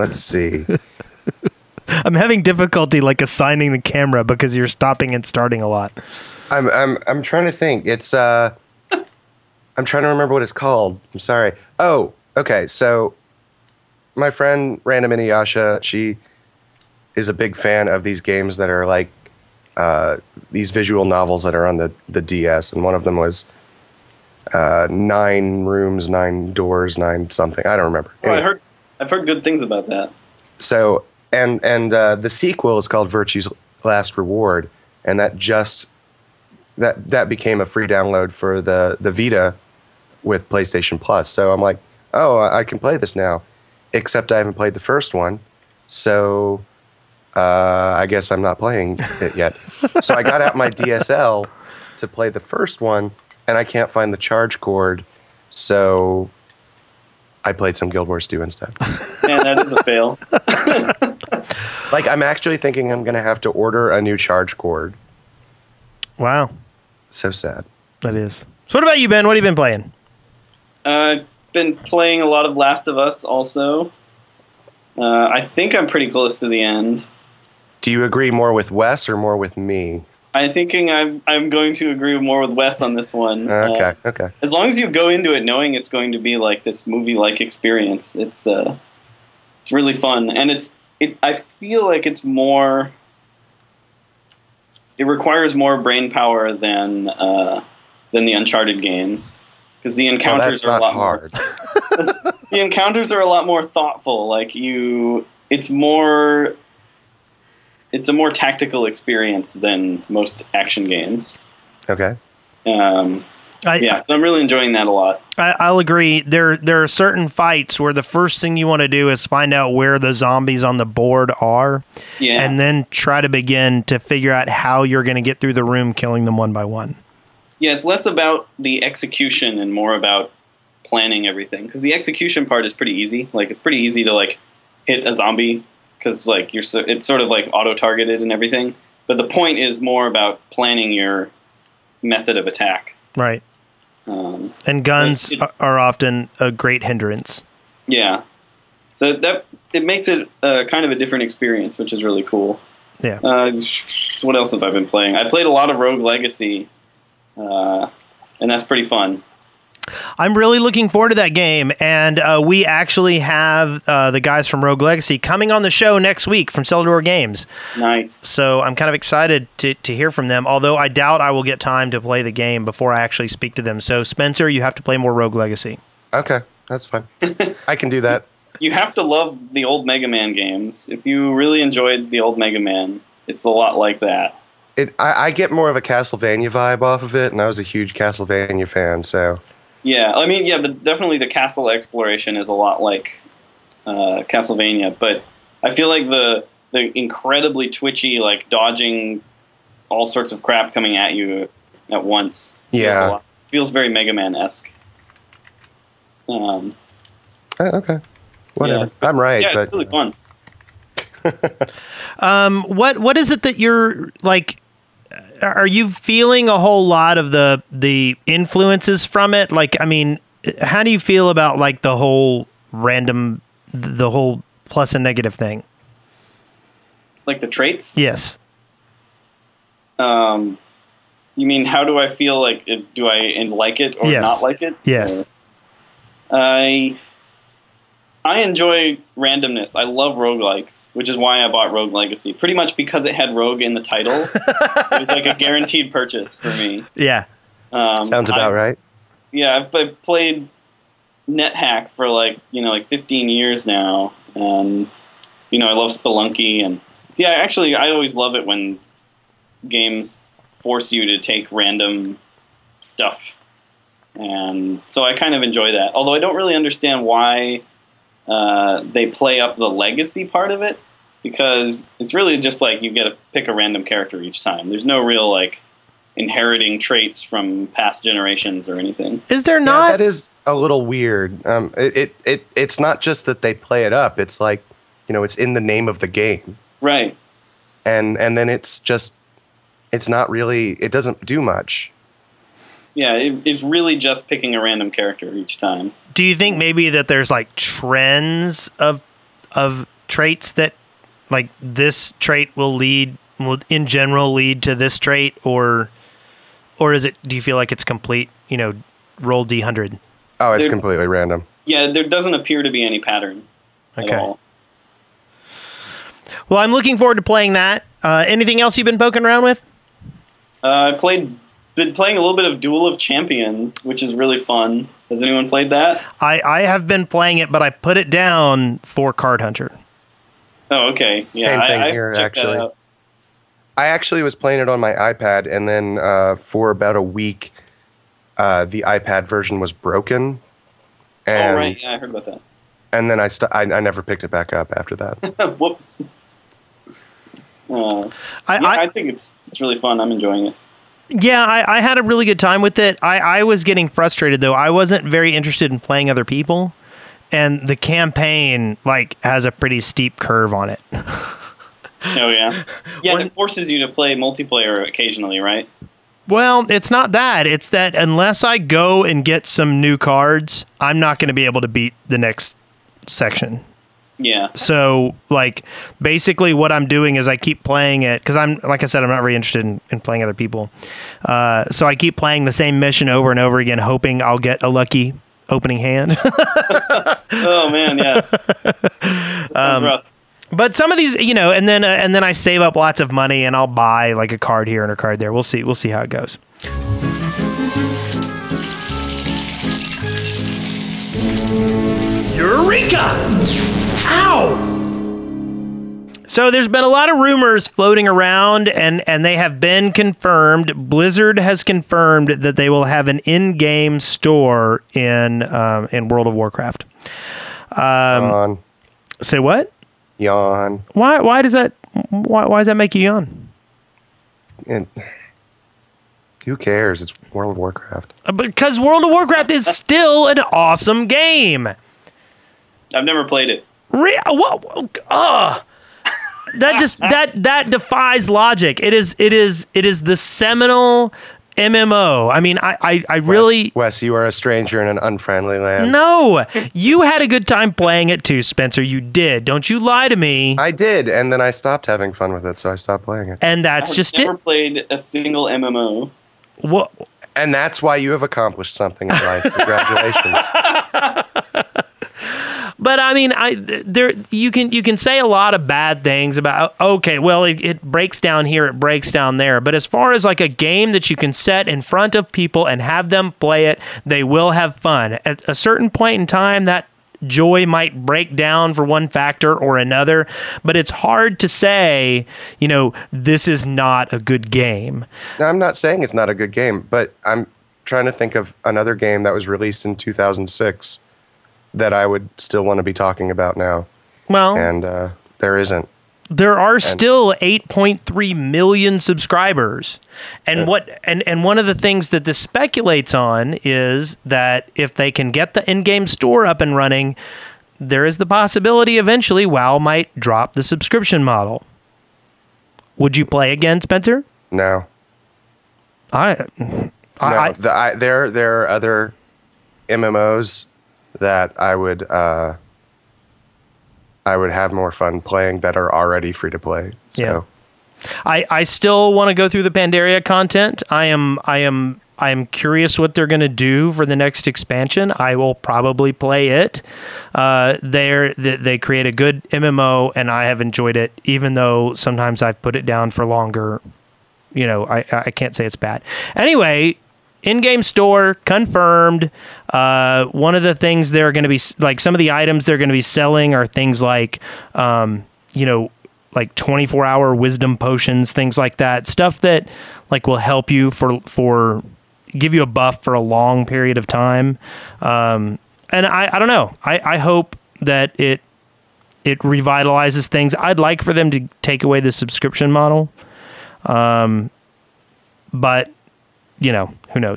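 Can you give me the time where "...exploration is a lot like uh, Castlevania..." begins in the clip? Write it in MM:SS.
03:11.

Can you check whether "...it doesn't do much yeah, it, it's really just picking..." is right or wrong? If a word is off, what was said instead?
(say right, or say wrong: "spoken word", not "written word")
right.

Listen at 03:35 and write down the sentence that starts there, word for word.
are you feeling a whole lot of the the influences from it?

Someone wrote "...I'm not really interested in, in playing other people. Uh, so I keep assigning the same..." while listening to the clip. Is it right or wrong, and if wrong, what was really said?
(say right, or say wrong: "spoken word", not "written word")
wrong: "playing", not "assigning".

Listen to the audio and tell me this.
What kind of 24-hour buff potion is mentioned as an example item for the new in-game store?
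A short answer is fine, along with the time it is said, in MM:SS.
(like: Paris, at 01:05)
wisdom potions, at 09:17.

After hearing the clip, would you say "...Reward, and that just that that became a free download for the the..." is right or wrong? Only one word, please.
right.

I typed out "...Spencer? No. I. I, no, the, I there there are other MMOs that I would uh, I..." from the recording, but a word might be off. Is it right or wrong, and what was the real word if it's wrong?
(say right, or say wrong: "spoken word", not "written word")
right.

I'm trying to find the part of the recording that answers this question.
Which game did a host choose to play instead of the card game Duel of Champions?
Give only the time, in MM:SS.
05:29.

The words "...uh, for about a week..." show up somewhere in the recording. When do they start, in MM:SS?
05:35.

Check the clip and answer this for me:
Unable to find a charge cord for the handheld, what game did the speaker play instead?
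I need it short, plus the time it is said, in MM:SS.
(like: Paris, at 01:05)
Guild Wars 2, at 00:57.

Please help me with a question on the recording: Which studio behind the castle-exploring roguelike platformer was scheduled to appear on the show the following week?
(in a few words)
Cellar Door Games.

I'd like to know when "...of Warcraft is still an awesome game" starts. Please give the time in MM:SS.
07:09.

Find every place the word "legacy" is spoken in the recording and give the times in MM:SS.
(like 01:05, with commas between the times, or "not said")
02:36, 02:44, 02:55, 04:01, 04:29.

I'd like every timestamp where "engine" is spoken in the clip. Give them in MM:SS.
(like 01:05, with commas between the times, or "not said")
not said.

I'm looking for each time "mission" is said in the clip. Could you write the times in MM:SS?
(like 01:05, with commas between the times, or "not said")
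06:22.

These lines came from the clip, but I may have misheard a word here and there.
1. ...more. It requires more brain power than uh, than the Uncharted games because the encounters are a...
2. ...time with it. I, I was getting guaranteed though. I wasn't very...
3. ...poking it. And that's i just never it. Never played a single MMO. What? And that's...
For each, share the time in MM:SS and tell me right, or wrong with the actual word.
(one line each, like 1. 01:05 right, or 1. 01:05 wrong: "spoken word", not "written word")
1. 01:32 right
2. 05:52 wrong: "frustrated", not "guaranteed"
3. 07:33 wrong: "playing", not "poking".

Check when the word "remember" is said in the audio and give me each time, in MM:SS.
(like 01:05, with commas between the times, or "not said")
00:10, 00:27.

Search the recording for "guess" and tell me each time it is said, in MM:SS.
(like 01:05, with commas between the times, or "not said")
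00:48.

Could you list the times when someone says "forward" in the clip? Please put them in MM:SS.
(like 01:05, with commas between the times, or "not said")
02:40, 05:16.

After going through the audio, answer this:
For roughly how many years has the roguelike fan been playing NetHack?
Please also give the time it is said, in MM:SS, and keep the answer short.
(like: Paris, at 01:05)
15, at 04:12.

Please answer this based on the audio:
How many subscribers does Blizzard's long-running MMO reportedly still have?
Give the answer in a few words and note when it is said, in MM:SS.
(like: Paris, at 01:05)
8.3 million, at 08:17.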